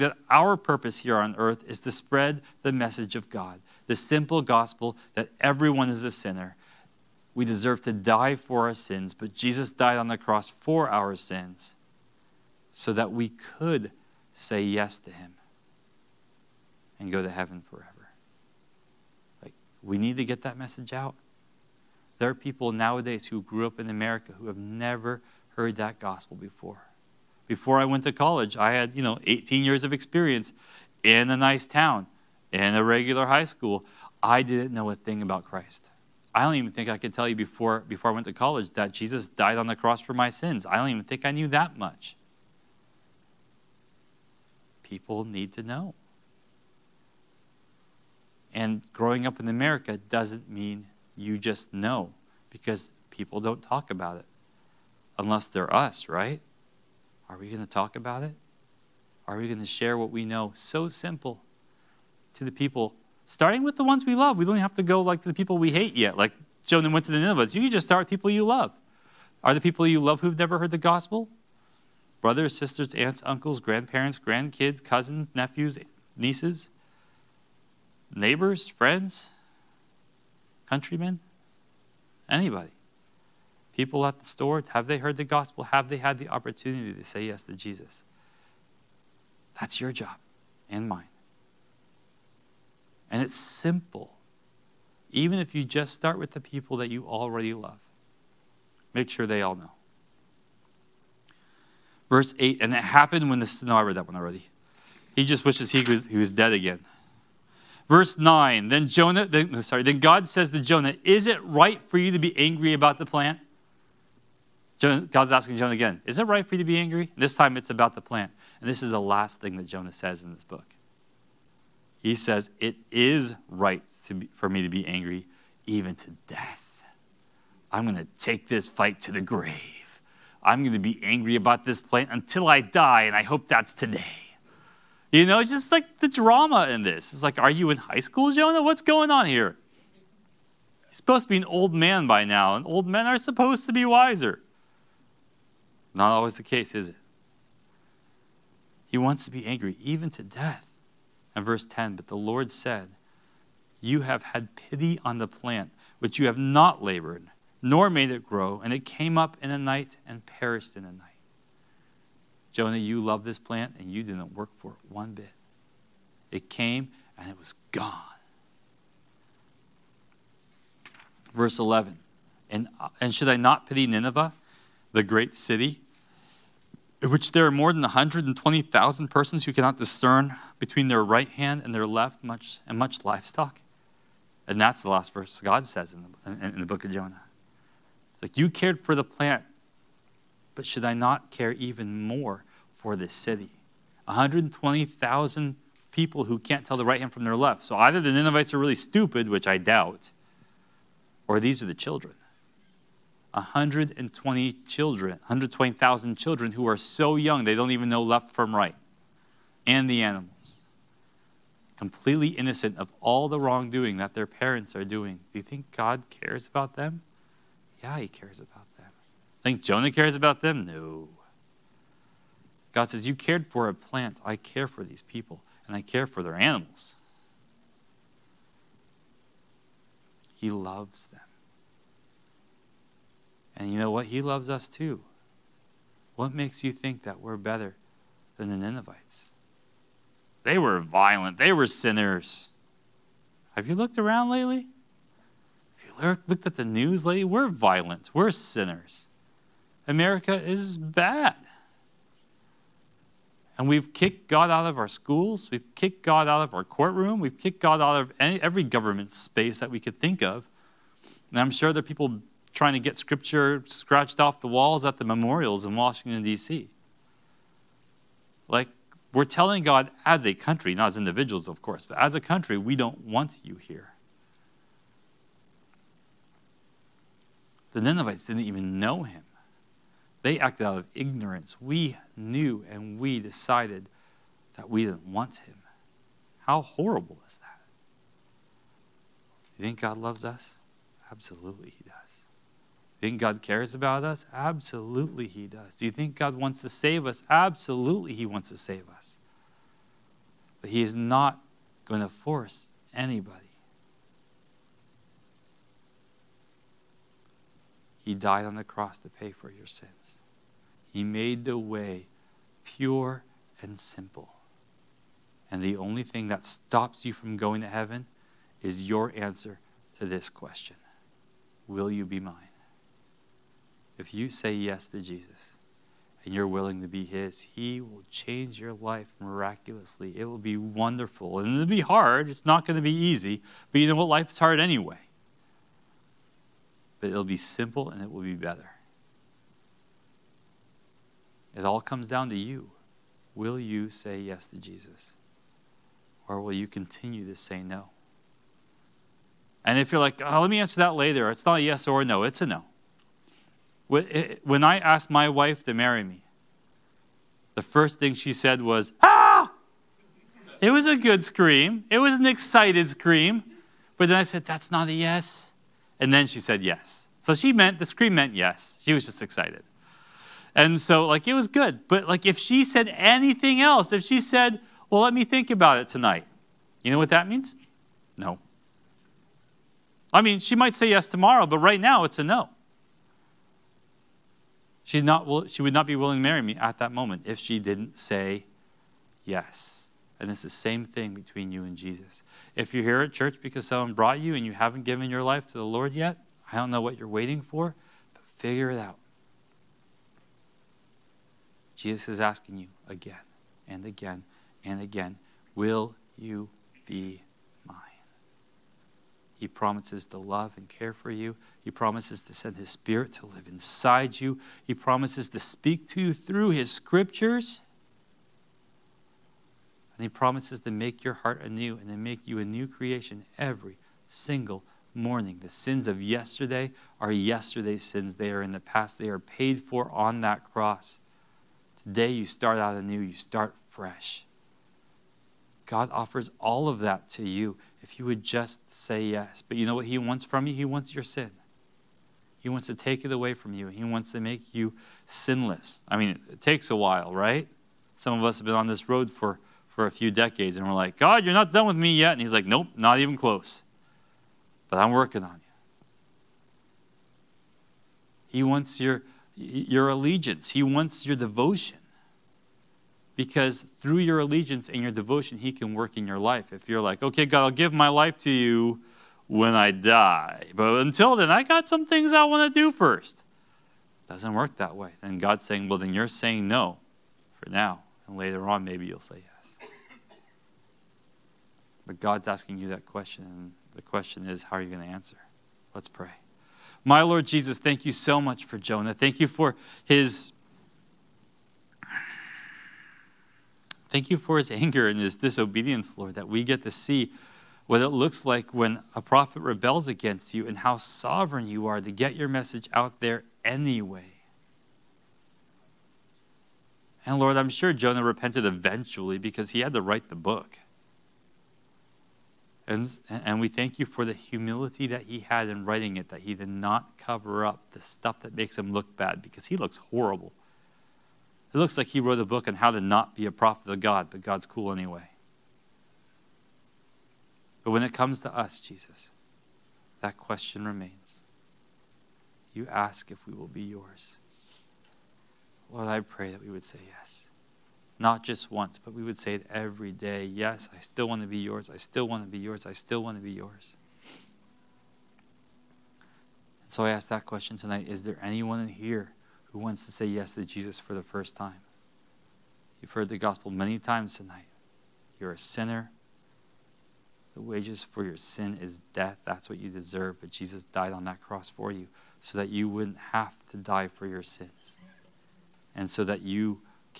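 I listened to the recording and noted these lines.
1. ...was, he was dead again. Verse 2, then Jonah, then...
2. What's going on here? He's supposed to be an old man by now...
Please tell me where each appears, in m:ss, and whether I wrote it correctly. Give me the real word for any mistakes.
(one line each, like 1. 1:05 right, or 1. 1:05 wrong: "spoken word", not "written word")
1. 1:45 wrong: "9", not "2"
2. 2:18 right.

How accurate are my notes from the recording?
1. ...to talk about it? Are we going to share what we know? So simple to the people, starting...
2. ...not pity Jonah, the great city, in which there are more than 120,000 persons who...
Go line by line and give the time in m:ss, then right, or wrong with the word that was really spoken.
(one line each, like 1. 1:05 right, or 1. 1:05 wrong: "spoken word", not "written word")
1. 0:57 right
2. 2:53 wrong: "Nineveh", not "Jonah".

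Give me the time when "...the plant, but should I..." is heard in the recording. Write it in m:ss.
3:08.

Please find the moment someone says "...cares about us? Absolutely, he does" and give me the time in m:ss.
4:53.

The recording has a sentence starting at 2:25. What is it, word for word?
Not always the case, is it?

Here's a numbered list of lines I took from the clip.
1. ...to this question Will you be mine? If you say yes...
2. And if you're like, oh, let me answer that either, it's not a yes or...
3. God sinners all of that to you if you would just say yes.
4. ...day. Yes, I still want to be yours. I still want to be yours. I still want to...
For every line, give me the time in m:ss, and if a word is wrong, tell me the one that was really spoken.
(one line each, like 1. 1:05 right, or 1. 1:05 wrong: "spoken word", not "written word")
1. 5:19 right
2. 5:49 wrong: "later", not "either"
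3. 7:15 wrong: "offers", not "sinners"
4. 8:59 right.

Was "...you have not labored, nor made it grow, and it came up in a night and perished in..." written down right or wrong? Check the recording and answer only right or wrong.
right.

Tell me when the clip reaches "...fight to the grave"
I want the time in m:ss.
2:08.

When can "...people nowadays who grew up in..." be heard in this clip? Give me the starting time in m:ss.
0:22.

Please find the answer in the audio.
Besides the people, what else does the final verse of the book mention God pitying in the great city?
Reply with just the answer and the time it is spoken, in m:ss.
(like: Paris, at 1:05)
much livestock, at 3:02.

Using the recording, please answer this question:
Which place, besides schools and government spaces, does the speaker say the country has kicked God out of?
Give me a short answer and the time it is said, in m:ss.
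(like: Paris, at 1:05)
courtroom, at 4:16.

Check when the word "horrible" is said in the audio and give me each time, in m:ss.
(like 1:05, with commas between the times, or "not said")
4:46, 8:39.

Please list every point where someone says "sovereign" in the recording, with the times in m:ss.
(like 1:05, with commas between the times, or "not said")
8:20.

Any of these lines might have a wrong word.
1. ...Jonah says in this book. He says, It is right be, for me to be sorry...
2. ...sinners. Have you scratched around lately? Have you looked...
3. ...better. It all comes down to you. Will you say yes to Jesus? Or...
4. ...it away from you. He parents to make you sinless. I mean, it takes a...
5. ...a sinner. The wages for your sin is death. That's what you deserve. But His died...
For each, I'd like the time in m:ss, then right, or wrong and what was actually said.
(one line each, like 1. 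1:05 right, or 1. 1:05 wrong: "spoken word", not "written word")
1. 1:59 wrong: "angry", not "sorry"
2. 4:01 wrong: "looked", not "scratched"
3. 5:38 right
4. 7:23 wrong: "wants", not "parents"
5. 9:15 wrong: "Jesus", not "His".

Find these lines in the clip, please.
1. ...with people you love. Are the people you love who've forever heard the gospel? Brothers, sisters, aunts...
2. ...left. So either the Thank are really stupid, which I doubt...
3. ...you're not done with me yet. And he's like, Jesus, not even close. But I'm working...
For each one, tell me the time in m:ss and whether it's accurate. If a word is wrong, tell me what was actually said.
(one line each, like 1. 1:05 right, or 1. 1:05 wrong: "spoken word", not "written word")
1. 1:08 wrong: "never", not "forever"
2. 3:17 wrong: "Ninevites", not "Thank"
3. 7:31 wrong: "Nope", not "Jesus".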